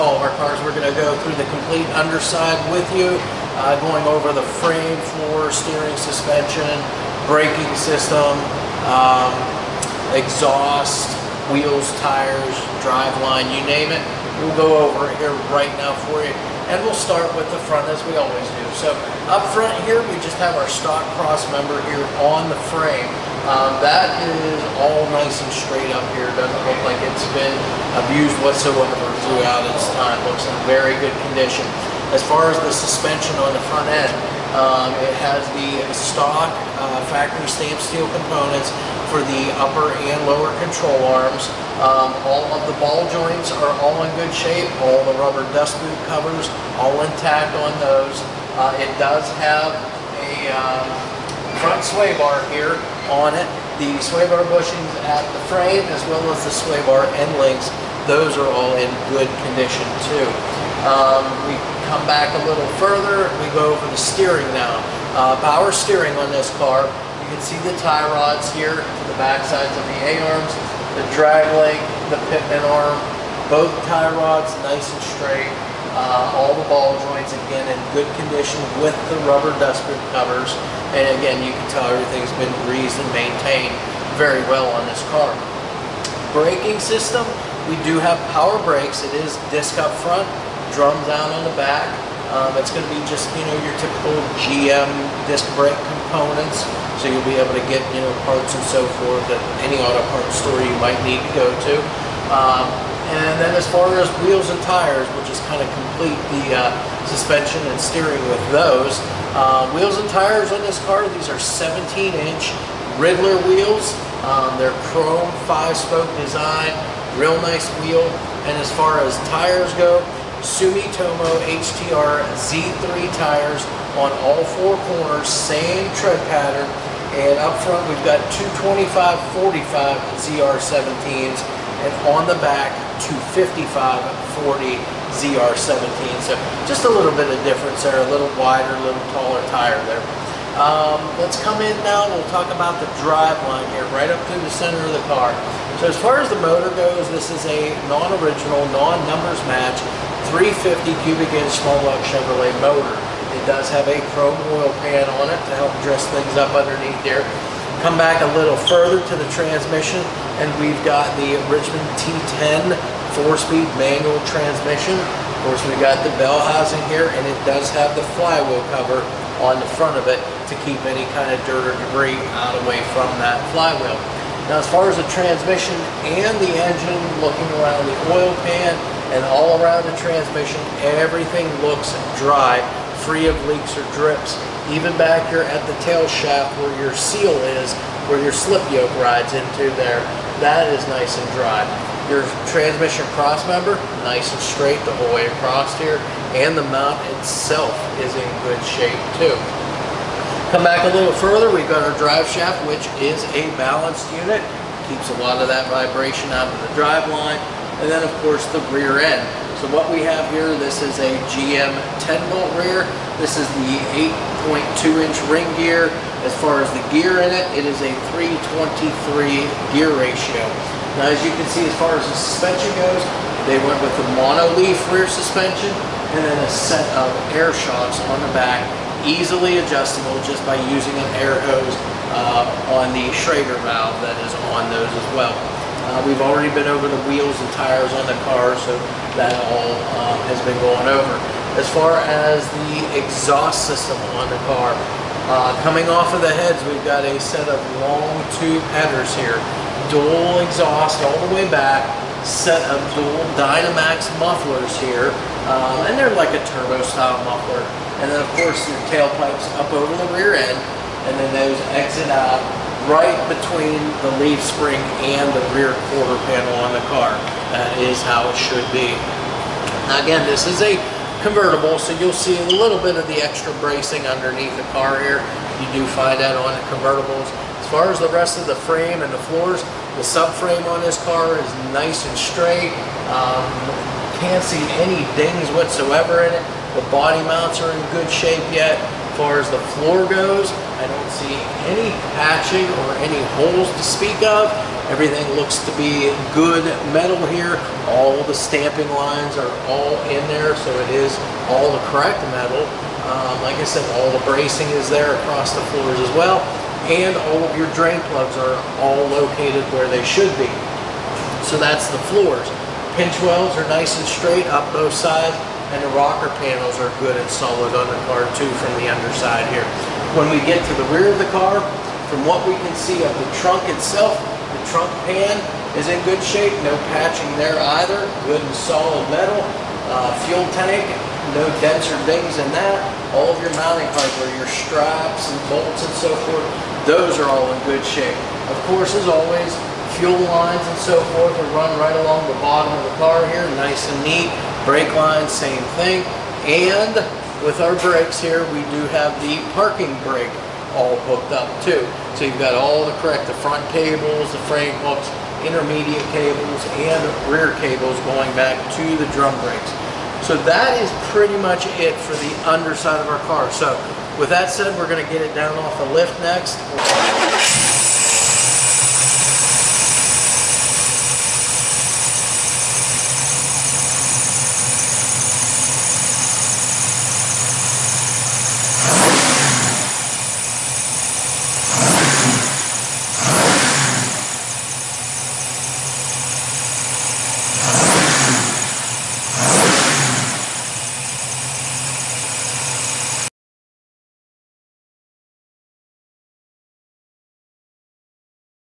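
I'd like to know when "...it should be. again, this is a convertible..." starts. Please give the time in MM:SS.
04:28.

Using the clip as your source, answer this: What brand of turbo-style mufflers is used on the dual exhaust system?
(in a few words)
Dynomax.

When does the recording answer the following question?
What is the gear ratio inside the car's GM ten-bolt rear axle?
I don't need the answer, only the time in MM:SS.
03:38.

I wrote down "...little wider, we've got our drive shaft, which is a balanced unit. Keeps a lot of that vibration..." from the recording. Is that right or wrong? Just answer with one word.
wrong.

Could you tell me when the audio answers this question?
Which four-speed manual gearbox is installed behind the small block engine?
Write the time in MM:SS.
02:41.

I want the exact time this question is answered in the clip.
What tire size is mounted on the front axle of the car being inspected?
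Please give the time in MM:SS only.
02:08.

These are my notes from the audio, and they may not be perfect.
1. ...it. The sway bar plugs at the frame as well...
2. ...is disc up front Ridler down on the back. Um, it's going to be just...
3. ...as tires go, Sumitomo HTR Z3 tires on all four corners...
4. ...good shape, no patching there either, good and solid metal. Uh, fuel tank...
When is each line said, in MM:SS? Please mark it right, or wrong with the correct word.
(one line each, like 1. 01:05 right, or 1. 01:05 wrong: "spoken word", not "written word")
1. 00:53 wrong: "bushings", not "plugs"
2. 01:29 wrong: "Drums", not "Ridler"
3. 01:58 right
4. 05:26 right.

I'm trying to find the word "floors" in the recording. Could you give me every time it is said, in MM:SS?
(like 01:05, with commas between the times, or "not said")
00:05, 04:39, 04:49, 05:05, 05:12.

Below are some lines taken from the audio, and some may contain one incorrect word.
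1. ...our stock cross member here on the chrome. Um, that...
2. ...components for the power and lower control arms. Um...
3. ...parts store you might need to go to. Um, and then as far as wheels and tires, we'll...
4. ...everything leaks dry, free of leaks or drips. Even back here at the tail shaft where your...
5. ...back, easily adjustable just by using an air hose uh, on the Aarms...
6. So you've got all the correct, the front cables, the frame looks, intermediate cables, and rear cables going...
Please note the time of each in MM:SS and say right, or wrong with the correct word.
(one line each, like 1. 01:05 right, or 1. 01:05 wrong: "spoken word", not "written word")
1. 00:20 wrong: "frame", not "chrome"
2. 00:38 wrong: "upper", not "power"
3. 01:40 right
4. 03:00 wrong: "looks", not "leaks"
5. 03:48 wrong: "Schrader", not "Aarms"
6. 05:52 wrong: "hooks", not "looks".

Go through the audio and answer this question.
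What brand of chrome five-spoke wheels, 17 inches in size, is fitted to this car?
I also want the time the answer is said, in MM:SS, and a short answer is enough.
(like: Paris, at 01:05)
Ridler, at 01:52.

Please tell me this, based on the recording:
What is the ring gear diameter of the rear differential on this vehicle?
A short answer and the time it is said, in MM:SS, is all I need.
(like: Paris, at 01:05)
8.2 inch, at 03:34.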